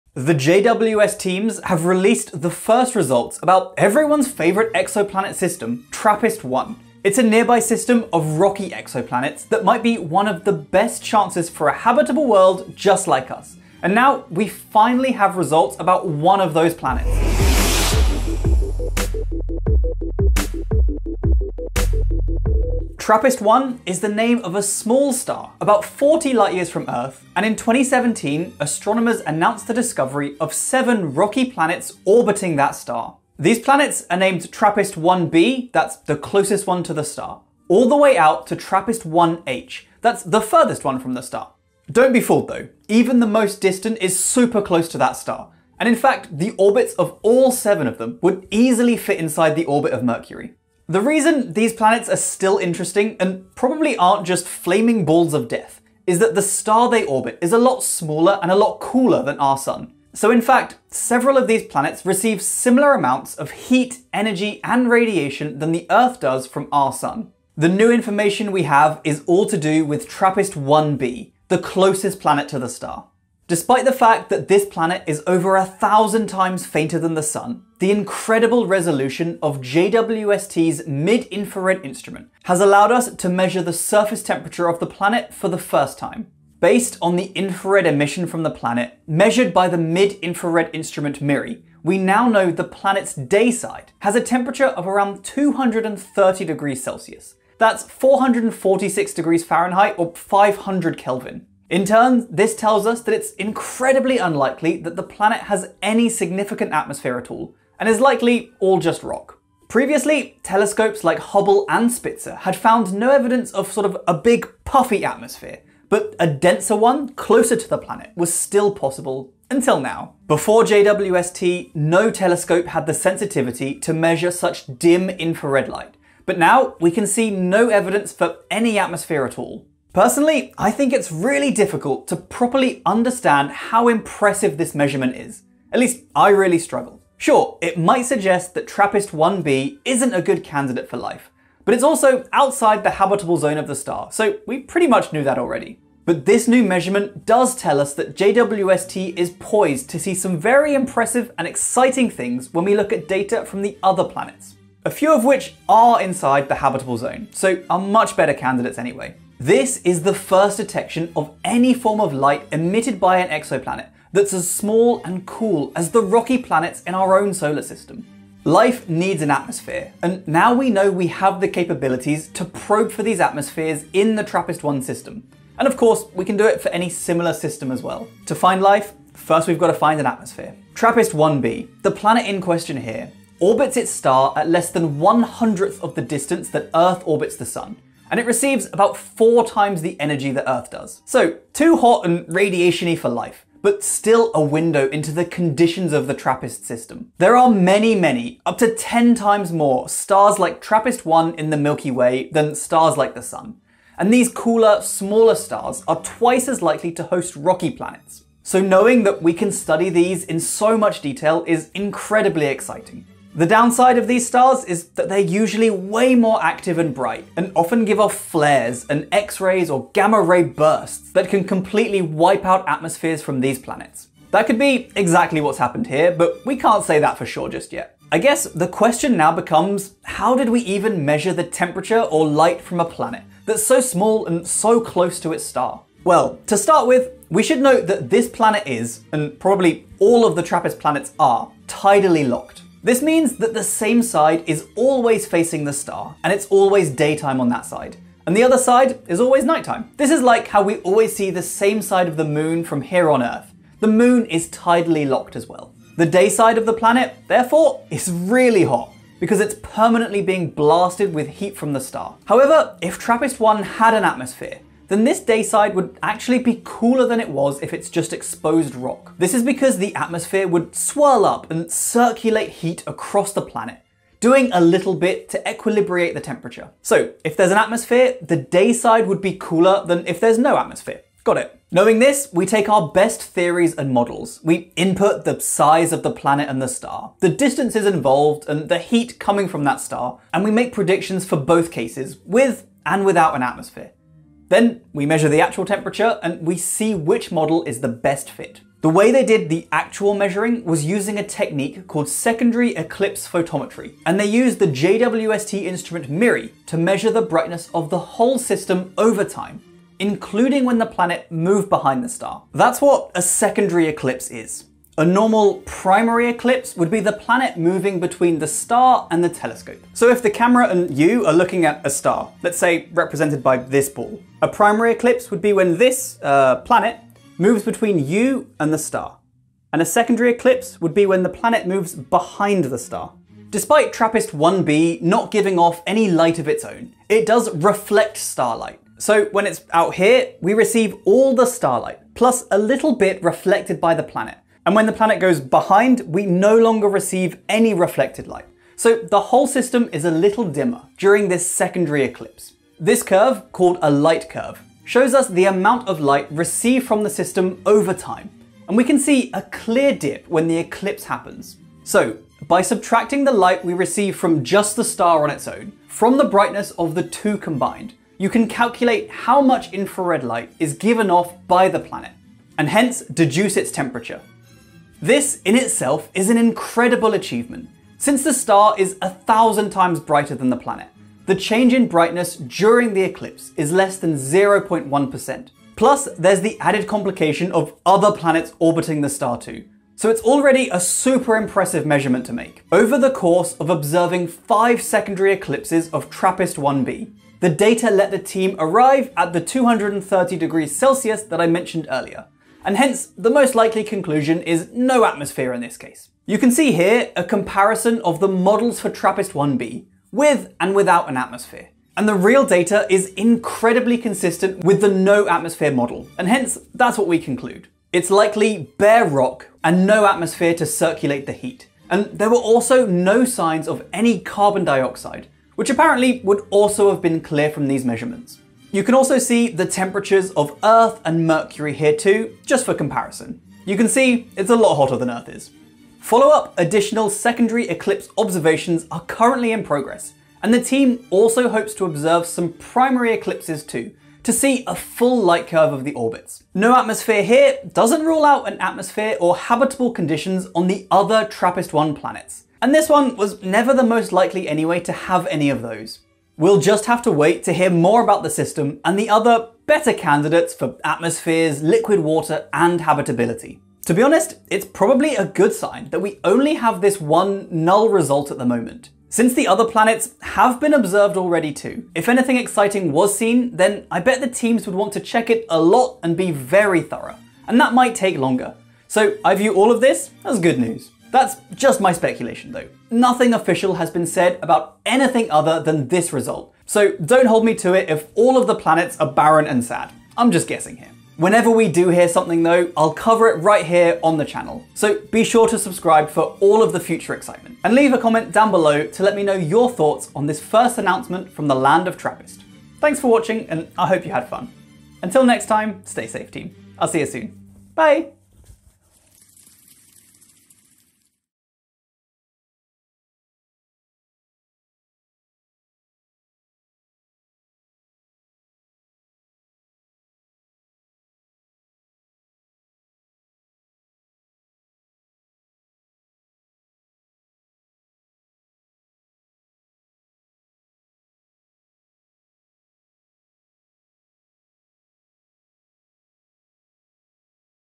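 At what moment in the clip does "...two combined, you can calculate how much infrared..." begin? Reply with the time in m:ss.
6:07.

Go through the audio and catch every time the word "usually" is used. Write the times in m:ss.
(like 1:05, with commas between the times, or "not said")
3:35.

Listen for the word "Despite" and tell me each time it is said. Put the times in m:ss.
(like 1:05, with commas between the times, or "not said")
1:13, 5:33.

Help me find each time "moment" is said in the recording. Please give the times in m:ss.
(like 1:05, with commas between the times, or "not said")
7:48.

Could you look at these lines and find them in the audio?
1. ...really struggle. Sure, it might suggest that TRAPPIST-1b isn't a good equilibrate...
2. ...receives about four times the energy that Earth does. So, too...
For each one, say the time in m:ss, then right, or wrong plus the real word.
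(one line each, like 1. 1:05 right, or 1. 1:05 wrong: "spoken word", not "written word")
1. 2:16 wrong: "candidate", not "equilibrate"
2. 3:08 right.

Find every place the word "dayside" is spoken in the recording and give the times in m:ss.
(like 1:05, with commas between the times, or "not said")
4:25, 4:38.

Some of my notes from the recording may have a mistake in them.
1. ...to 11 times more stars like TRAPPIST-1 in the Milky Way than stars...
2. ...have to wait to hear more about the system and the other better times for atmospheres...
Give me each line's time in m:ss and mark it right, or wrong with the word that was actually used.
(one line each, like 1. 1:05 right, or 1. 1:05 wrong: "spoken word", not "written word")
1. 3:18 wrong: "10", not "11"
2. 7:36 wrong: "candidates", not "times".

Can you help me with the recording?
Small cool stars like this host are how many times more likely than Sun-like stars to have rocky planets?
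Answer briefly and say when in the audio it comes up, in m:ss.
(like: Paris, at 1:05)
twice, at 3:26.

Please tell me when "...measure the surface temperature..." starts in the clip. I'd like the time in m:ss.
1:23.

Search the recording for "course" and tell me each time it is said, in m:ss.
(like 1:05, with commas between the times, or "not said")
2:55, 6:33.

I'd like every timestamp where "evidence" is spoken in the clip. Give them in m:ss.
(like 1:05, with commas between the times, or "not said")
1:53, 2:07.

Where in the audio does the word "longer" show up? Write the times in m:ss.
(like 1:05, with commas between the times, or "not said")
5:46, 7:58.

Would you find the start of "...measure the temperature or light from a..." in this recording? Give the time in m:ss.
3:51.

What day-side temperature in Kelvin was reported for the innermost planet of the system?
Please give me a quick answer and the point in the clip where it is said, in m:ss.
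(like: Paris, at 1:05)
500 Kelvin, at 1:40.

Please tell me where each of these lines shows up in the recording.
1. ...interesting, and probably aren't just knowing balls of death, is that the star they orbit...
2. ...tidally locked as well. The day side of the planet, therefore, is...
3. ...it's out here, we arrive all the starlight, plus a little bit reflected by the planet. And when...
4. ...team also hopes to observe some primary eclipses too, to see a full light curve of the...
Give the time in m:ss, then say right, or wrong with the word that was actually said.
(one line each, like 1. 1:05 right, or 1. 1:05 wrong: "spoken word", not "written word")
1. 0:52 wrong: "flaming", not "knowing"
2. 4:14 right
3. 5:39 wrong: "receive", not "arrive"
4. 7:20 right.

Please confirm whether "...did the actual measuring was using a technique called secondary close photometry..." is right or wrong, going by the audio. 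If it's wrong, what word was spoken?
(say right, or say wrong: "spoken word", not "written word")
wrong: "eclipse", not "close".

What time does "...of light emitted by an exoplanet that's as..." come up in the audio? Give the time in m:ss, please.
2:41.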